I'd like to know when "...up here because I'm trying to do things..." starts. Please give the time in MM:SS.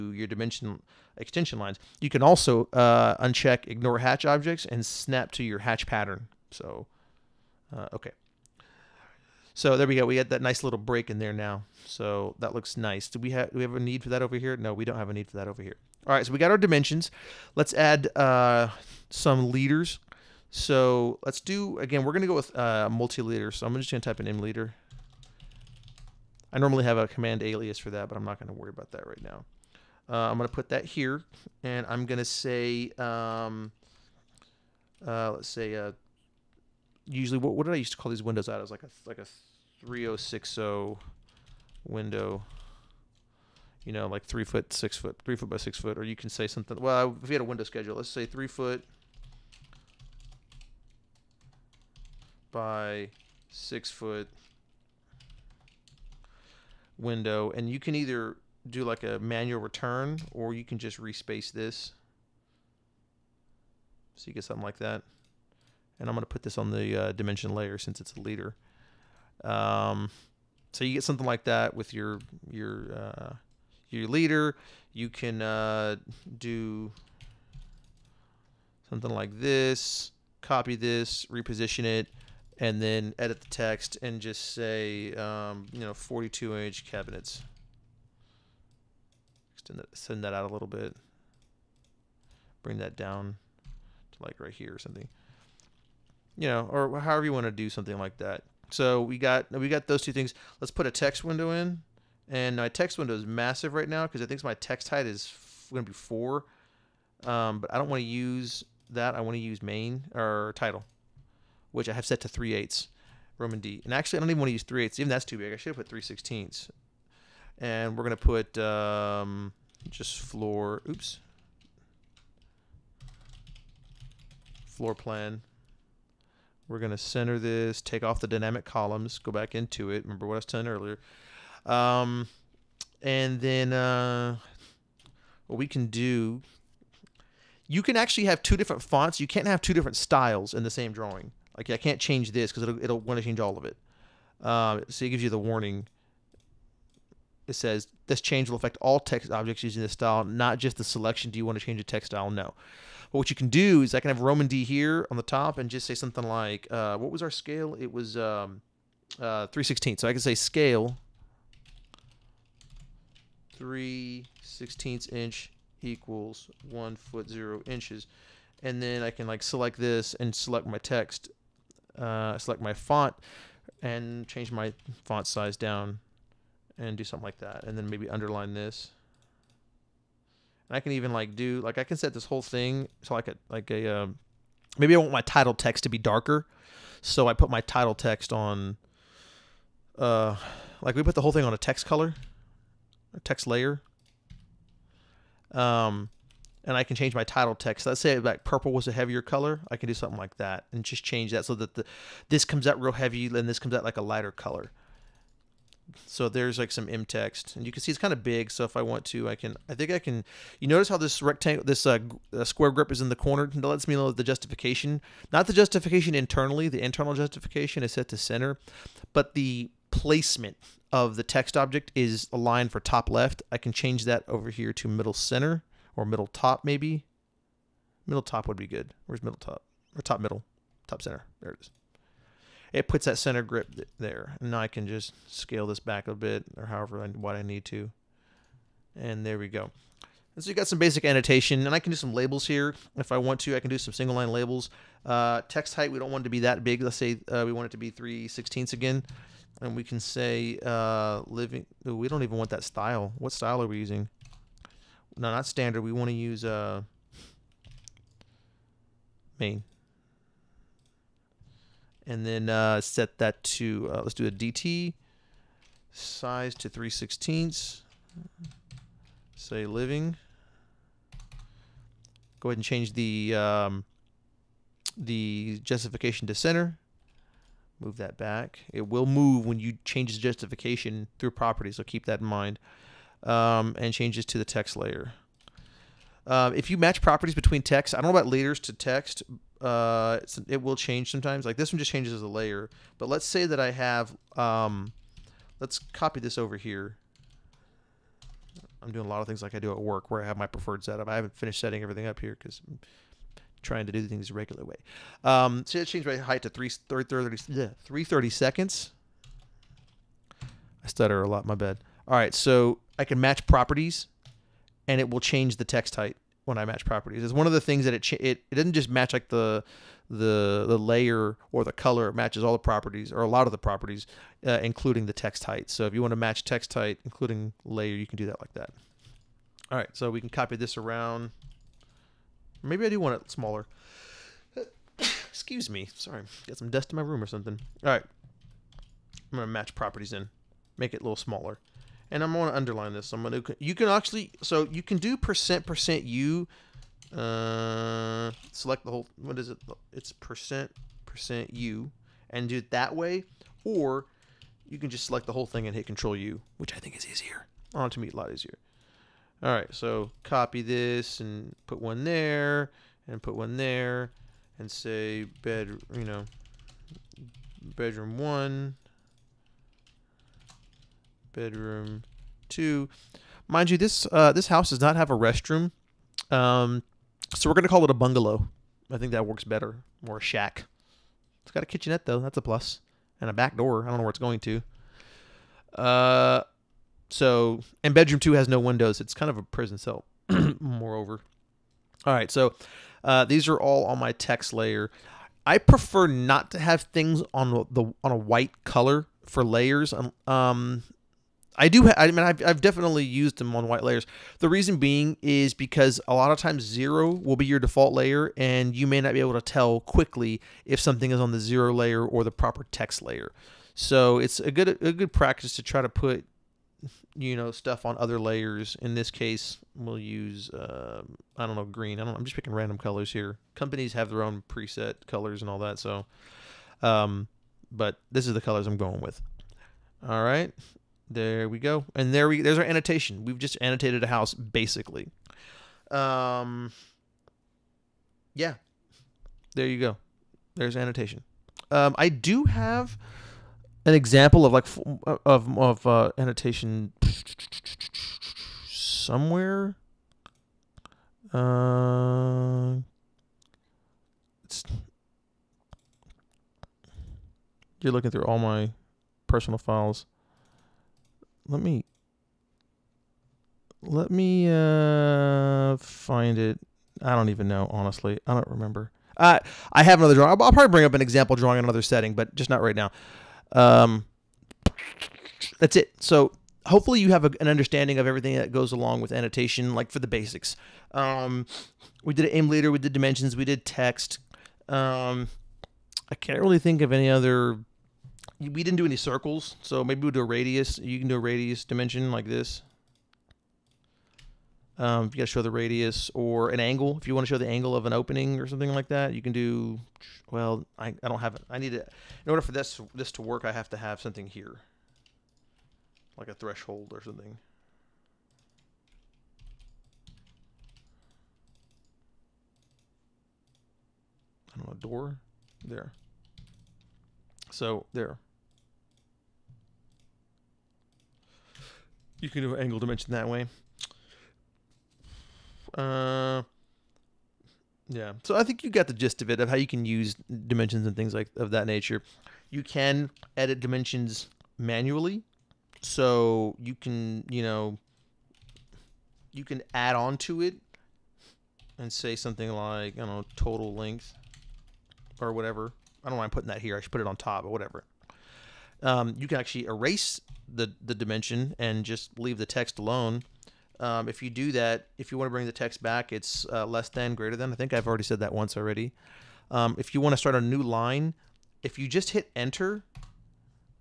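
05:02.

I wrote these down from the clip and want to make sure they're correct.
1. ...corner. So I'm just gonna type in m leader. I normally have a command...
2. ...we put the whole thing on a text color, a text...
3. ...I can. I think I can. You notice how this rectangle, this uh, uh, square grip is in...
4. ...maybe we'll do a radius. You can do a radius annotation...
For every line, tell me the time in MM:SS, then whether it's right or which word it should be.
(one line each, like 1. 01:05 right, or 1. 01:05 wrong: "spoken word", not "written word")
1. 00:23 wrong: "leader", not "corner"
2. 03:10 right
3. 03:29 right
4. 08:09 wrong: "dimension", not "annotation".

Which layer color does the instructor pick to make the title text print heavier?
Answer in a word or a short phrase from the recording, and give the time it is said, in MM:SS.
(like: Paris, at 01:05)
Purple, at 03:18.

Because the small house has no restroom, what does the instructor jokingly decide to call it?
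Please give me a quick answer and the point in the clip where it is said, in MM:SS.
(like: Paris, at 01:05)
Bungalow, at 06:17.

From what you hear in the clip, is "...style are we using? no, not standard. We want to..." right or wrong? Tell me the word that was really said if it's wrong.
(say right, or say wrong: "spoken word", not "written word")
right.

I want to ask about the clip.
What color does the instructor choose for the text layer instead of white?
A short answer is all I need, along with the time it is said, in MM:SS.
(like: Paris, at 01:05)
Green, at 07:01.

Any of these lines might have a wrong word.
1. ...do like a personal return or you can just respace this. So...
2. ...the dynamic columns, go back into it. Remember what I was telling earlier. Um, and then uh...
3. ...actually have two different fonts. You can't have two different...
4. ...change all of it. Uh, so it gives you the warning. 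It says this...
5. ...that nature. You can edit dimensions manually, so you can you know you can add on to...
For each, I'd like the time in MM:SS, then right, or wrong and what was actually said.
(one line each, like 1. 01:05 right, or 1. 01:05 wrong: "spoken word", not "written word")
1. 00:58 wrong: "manual", not "personal"
2. 02:08 right
3. 02:17 right
4. 02:23 right
5. 08:51 right.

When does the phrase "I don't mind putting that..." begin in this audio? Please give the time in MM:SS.
09:06.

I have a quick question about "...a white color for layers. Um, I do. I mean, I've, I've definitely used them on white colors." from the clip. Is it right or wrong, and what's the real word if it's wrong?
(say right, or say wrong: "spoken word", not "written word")
wrong: "layers", not "colors".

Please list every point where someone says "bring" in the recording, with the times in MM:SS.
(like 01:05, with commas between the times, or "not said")
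01:32, 07:50, 09:15.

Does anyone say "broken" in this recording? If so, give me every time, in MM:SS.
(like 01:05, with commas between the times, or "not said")
not said.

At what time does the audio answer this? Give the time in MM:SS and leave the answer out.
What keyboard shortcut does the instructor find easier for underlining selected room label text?
05:55.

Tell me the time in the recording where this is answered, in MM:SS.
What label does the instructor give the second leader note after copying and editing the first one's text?
01:25.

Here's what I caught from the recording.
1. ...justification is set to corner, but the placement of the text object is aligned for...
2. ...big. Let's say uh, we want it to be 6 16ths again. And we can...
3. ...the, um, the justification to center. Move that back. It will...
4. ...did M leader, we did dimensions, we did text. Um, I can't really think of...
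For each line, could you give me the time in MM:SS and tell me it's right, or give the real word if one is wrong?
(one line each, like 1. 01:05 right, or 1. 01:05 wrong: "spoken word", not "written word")
1. 03:37 wrong: "center", not "corner"
2. 04:06 wrong: "3", not "6"
3. 04:32 right
4. 08:02 right.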